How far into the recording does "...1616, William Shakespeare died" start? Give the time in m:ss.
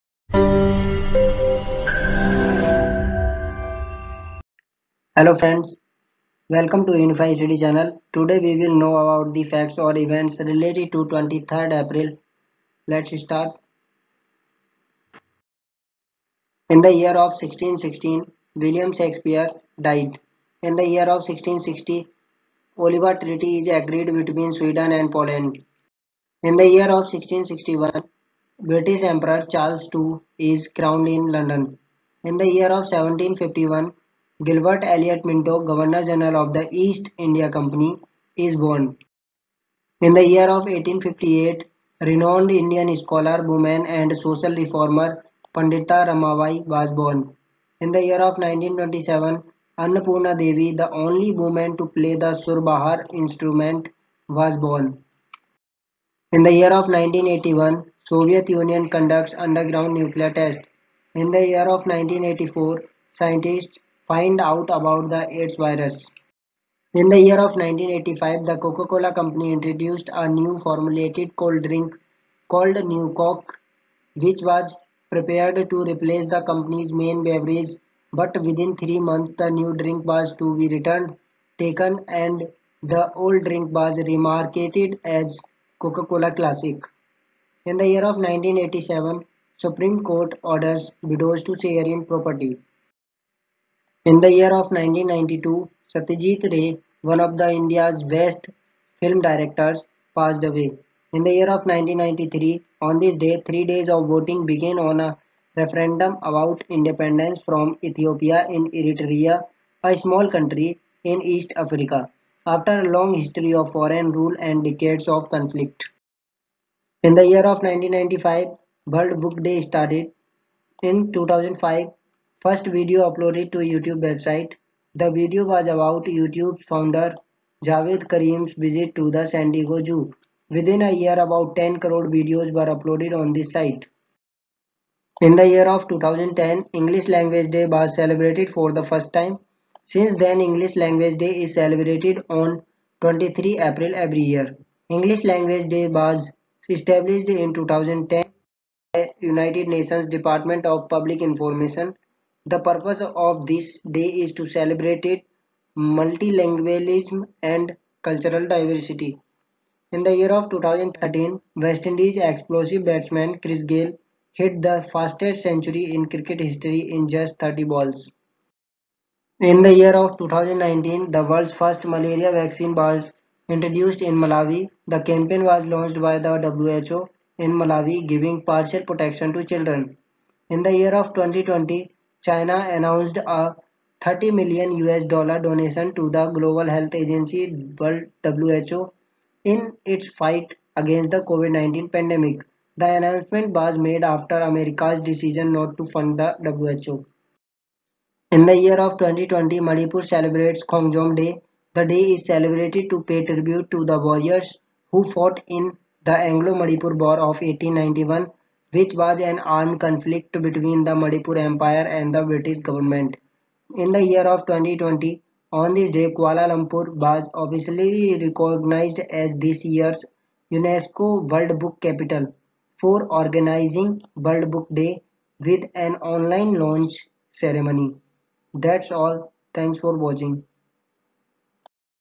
0:17.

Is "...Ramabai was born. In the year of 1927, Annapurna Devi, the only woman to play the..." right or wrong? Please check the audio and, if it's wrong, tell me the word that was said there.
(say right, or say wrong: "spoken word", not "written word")
right.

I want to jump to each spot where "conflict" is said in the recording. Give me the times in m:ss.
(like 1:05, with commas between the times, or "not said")
1:55, 3:29.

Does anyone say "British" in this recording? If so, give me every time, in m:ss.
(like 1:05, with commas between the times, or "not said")
0:28, 3:32.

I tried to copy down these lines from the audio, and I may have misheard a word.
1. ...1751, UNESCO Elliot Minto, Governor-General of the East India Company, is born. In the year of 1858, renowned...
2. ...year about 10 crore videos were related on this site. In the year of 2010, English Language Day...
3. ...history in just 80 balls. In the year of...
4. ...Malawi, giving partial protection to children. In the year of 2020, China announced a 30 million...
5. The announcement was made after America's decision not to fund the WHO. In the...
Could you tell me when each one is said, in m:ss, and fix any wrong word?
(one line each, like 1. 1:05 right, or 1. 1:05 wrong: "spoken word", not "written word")
1. 0:32 wrong: "Gilbert", not "UNESCO"
2. 2:10 wrong: "uploaded", not "related"
3. 2:46 wrong: "30", not "80"
4. 2:57 right
5. 3:12 right.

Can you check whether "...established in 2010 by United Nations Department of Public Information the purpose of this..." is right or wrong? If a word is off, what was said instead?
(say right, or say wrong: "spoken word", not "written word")
right.